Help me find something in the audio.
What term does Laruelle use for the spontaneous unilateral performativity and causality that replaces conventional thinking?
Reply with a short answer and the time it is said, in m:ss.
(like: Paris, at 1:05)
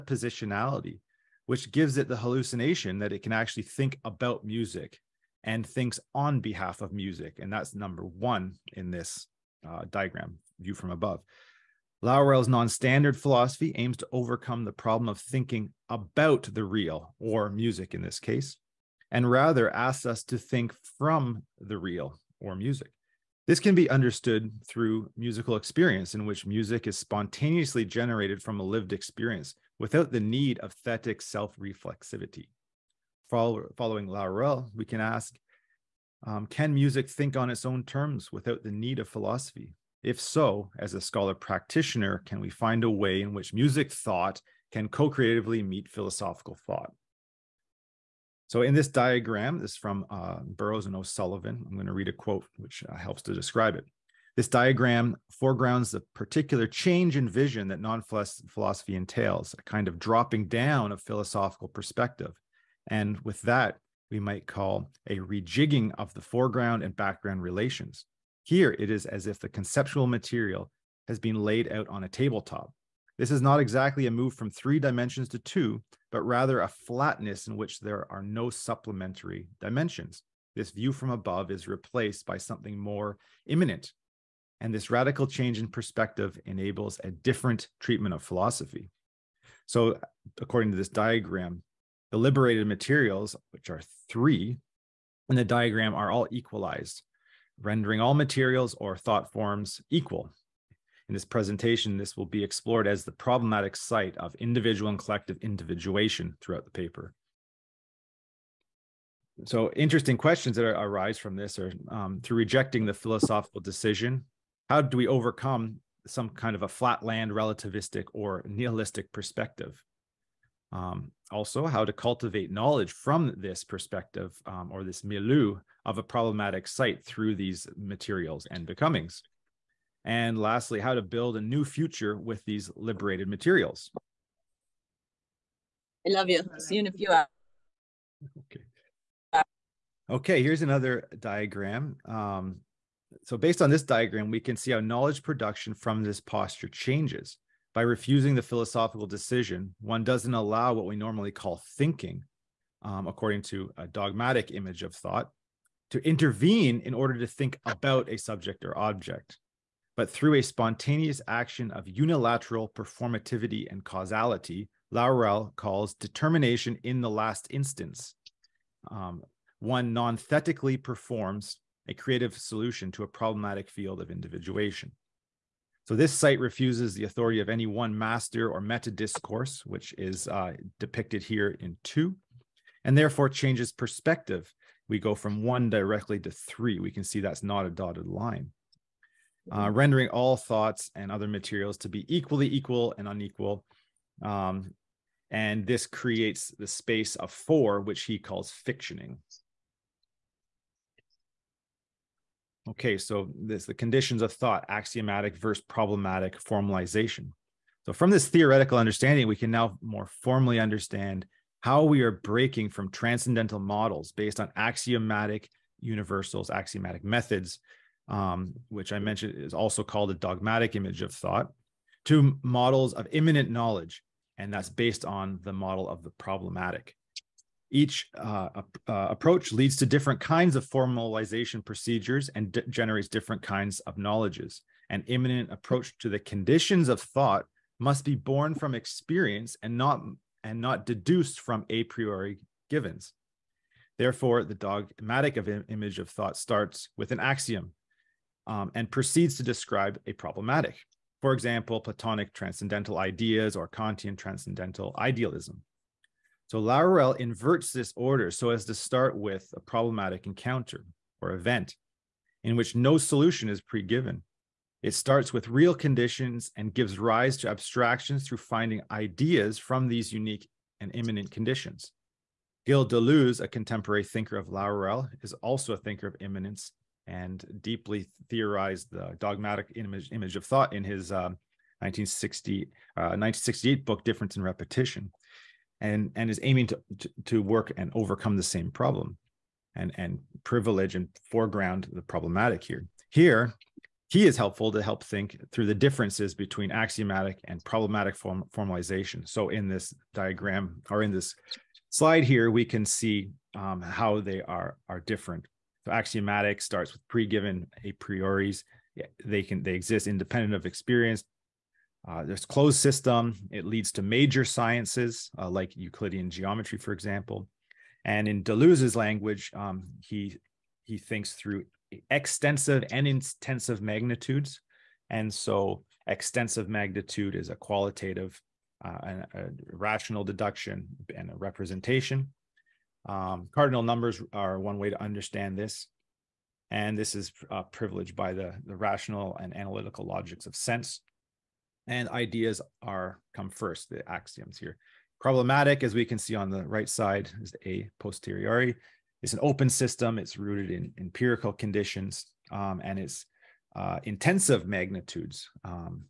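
determination in the last instance, at 2:45.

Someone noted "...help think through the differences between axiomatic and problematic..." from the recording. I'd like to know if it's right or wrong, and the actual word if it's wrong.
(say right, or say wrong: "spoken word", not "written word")
right.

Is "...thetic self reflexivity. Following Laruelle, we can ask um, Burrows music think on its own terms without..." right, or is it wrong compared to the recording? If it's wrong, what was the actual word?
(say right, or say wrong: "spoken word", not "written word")
wrong: "Can", not "Burrows".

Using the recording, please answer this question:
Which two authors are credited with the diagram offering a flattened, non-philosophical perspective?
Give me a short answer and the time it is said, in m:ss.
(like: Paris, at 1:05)
Burrows and O'Sullivan, at 0:50.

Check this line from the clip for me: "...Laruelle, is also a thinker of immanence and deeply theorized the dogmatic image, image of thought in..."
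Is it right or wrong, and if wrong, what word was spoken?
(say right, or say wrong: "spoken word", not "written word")
right.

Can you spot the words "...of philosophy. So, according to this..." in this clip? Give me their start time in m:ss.
1:28.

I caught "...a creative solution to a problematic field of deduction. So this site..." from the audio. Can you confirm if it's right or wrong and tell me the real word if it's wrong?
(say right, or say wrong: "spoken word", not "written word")
wrong: "individuation", not "deduction".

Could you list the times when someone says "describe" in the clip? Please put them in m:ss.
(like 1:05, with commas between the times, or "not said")
0:53, 4:09.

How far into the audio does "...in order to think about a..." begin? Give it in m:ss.
2:36.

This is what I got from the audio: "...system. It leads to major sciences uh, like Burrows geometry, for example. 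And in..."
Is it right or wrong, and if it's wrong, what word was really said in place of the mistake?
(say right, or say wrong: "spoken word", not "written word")
wrong: "Euclidean", not "Burrows".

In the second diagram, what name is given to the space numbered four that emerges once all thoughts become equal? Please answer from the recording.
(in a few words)
fictioning.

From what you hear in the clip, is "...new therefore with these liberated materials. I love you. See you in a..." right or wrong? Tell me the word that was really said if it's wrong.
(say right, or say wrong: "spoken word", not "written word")
wrong: "future", not "therefore".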